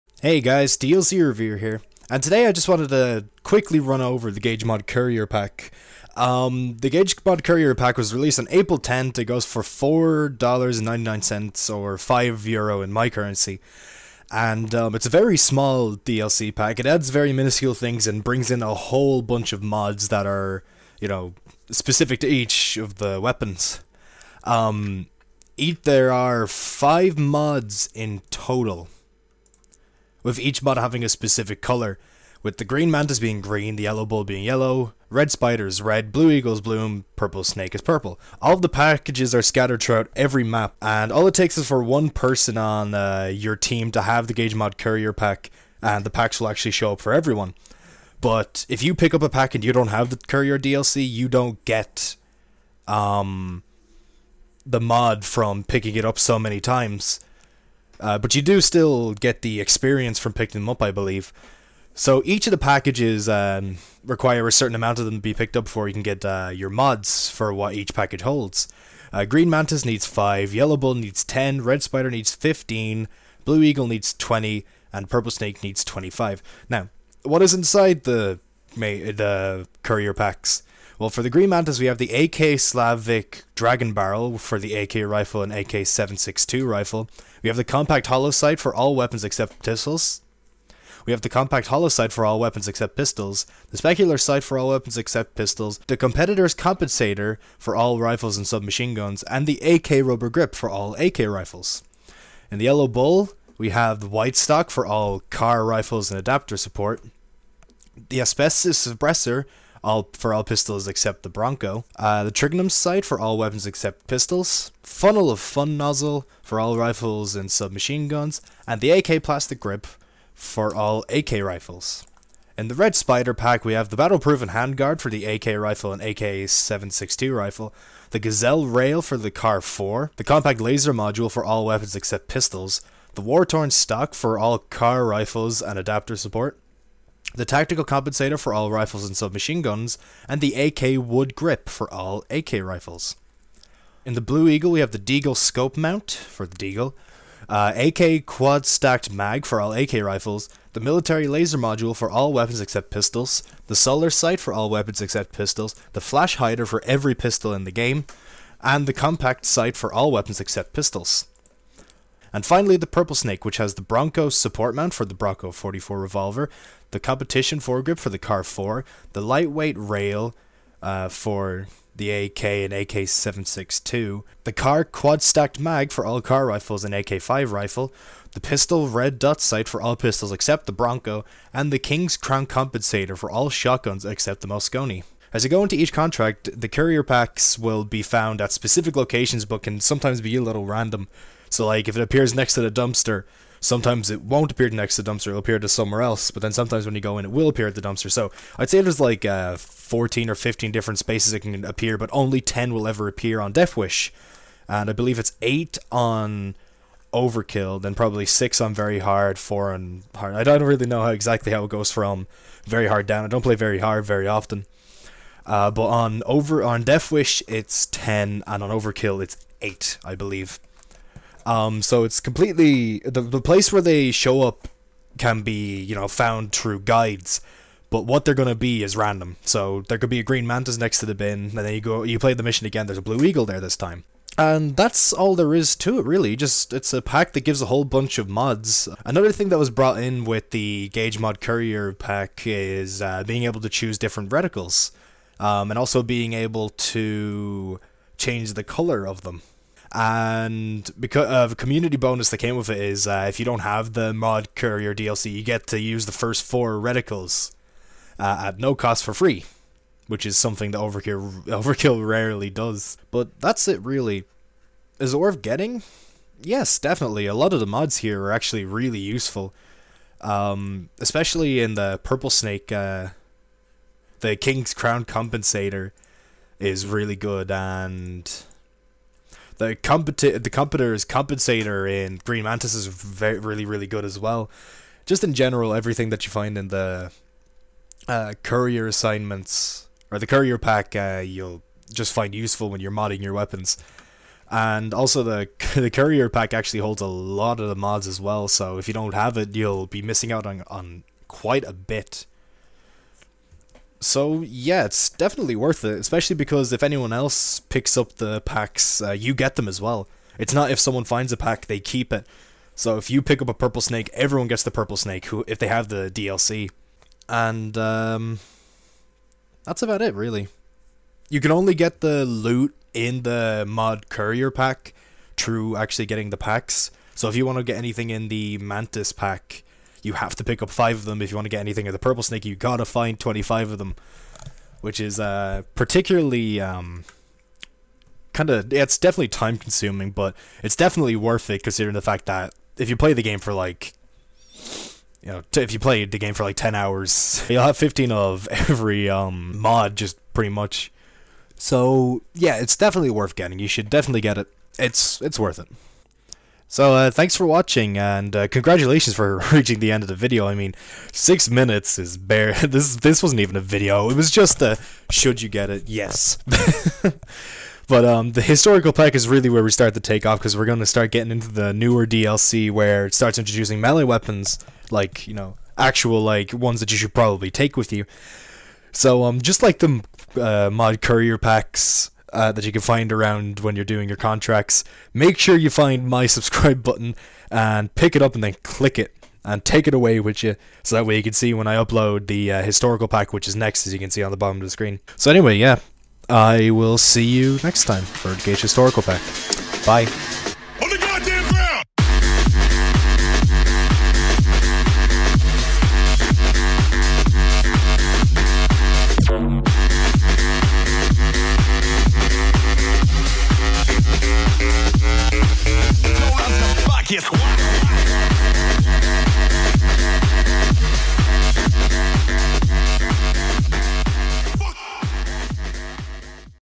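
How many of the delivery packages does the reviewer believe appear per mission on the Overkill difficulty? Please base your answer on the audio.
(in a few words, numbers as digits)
8.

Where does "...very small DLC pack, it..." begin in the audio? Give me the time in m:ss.
0:15.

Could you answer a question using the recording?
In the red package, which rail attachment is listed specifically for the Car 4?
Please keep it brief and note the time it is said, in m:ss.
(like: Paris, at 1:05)
Gazelle rail, at 2:08.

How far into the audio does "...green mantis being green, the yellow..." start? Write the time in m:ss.
0:32.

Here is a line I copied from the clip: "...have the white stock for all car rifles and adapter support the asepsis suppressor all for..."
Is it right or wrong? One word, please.
right.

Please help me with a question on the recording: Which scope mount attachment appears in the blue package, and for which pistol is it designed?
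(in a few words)
Deagle scope mount.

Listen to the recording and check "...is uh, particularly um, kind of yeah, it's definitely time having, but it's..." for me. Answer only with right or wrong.
wrong.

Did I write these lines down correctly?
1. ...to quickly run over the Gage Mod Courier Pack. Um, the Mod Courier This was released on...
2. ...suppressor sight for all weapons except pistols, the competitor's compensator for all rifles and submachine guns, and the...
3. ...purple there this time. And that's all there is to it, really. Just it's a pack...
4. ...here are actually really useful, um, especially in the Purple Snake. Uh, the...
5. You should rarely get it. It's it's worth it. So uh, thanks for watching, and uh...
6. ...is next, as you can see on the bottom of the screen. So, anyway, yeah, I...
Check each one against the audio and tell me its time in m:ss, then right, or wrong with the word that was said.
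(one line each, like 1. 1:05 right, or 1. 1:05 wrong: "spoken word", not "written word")
1. 0:02 wrong: "Pack", not "This"
2. 1:33 wrong: "speculator", not "suppressor"
3. 3:53 wrong: "eagle", not "purple"
4. 4:27 right
5. 5:53 wrong: "definitely", not "rarely"
6. 6:33 right.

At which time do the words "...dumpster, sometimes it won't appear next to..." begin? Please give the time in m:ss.
3:12.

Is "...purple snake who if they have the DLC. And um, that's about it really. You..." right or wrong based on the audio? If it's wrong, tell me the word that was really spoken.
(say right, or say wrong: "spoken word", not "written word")
right.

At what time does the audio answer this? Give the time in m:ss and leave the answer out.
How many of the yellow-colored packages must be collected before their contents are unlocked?
1:10.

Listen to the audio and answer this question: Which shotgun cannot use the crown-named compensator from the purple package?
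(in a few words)
Mosconi.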